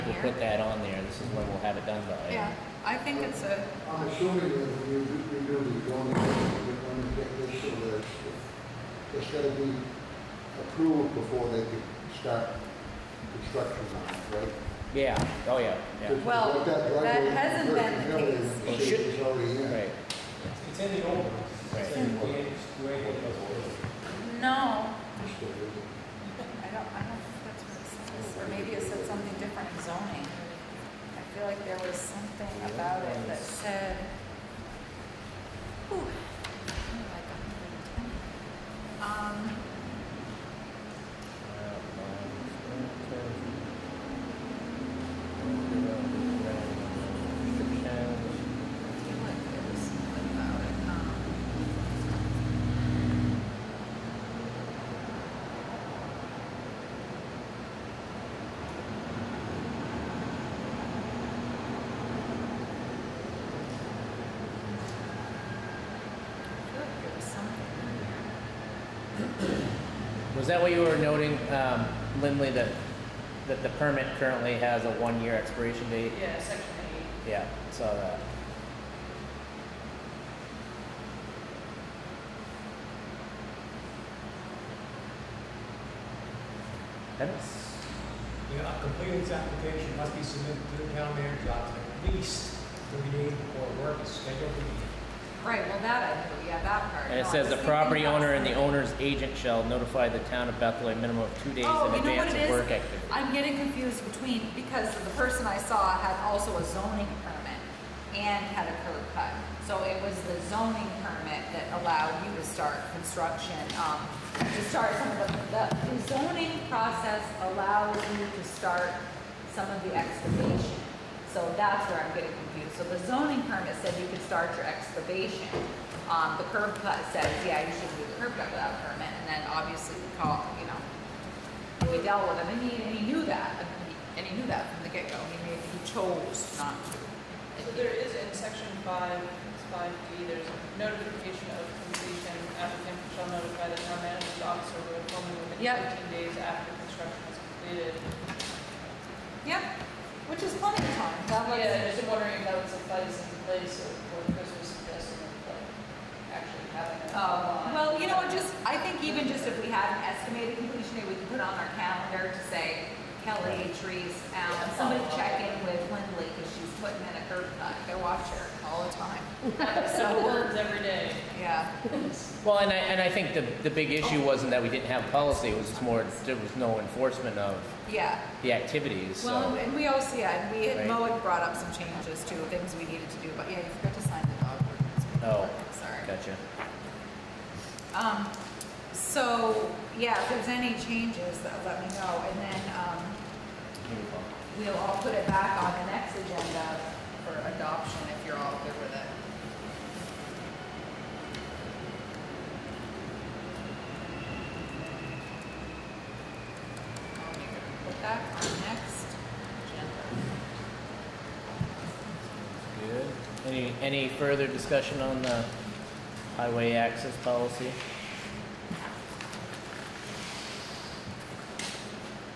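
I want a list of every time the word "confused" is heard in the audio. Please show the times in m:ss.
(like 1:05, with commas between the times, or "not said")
1:43, 2:02.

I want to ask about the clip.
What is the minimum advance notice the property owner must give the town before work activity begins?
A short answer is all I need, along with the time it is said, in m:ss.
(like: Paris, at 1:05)
2 days, at 1:41.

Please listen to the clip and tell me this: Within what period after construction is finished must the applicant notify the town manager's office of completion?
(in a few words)
15 days.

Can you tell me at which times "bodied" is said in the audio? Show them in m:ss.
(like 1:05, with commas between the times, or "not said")
not said.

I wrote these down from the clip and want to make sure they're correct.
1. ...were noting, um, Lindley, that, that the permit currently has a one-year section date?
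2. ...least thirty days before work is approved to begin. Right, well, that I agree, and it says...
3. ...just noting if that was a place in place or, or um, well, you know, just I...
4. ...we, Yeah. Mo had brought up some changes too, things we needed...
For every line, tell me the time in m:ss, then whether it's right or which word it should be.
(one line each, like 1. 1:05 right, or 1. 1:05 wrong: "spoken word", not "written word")
1. 1:10 wrong: "expiration", not "section"
2. 1:32 wrong: "scheduled", not "approved"
3. 2:31 wrong: "wondering", not "noting"
4. 3:00 wrong: "Right", not "Yeah".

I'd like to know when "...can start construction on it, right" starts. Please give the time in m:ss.
0:11.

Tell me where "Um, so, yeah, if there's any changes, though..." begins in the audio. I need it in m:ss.
3:07.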